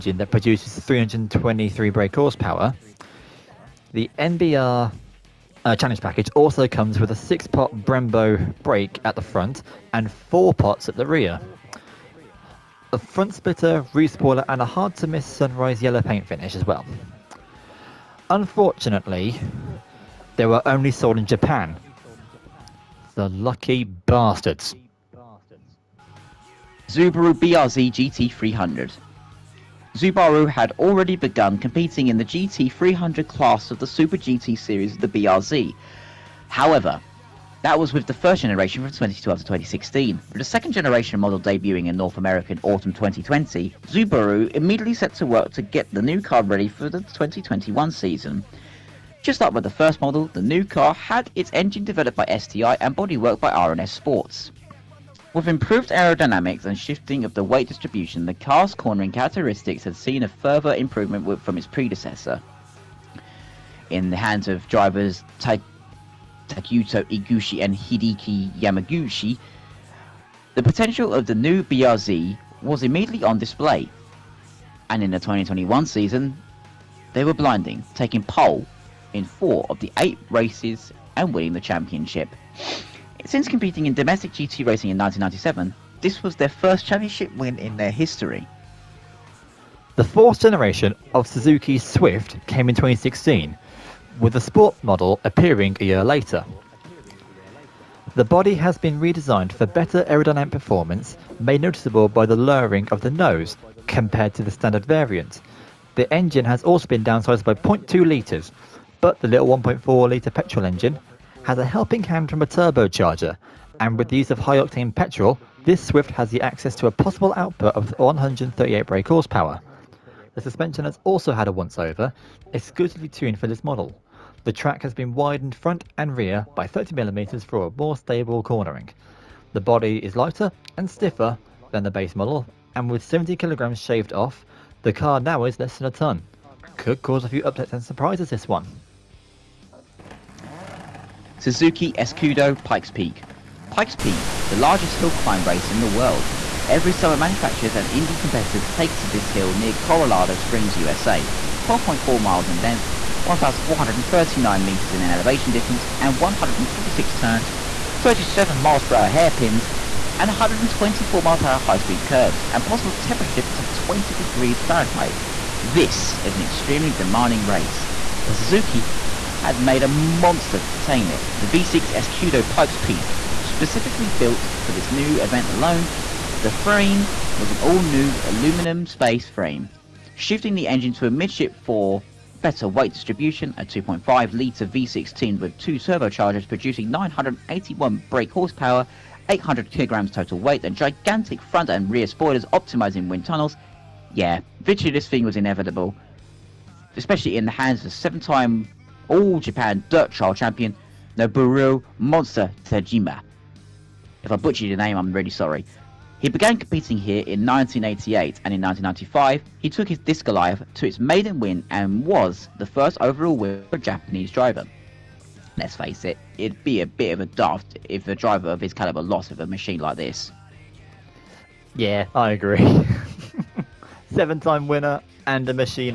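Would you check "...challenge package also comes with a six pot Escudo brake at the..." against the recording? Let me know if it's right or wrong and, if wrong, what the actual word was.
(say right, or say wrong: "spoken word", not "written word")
wrong: "Brembo", not "Escudo".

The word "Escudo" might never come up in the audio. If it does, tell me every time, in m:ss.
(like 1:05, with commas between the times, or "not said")
2:21, 2:51.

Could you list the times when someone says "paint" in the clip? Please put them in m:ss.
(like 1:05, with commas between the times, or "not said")
0:16.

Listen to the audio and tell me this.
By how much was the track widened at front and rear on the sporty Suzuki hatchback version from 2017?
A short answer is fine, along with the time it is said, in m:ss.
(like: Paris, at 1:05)
30mm, at 2:06.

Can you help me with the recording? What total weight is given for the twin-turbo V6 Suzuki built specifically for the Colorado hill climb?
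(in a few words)
800 kilograms.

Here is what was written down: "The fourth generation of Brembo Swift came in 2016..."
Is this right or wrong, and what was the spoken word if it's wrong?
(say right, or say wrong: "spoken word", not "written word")
wrong: "Suzuki", not "Brembo".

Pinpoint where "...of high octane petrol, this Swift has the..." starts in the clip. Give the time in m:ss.
1:54.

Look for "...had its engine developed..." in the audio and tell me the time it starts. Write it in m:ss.
0:50.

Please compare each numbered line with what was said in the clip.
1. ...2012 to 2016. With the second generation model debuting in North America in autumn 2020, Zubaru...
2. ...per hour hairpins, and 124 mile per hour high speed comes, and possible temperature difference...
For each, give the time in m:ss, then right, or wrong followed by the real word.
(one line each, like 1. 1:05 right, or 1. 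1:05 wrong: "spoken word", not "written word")
1. 0:38 right
2. 2:38 wrong: "curves", not "comes".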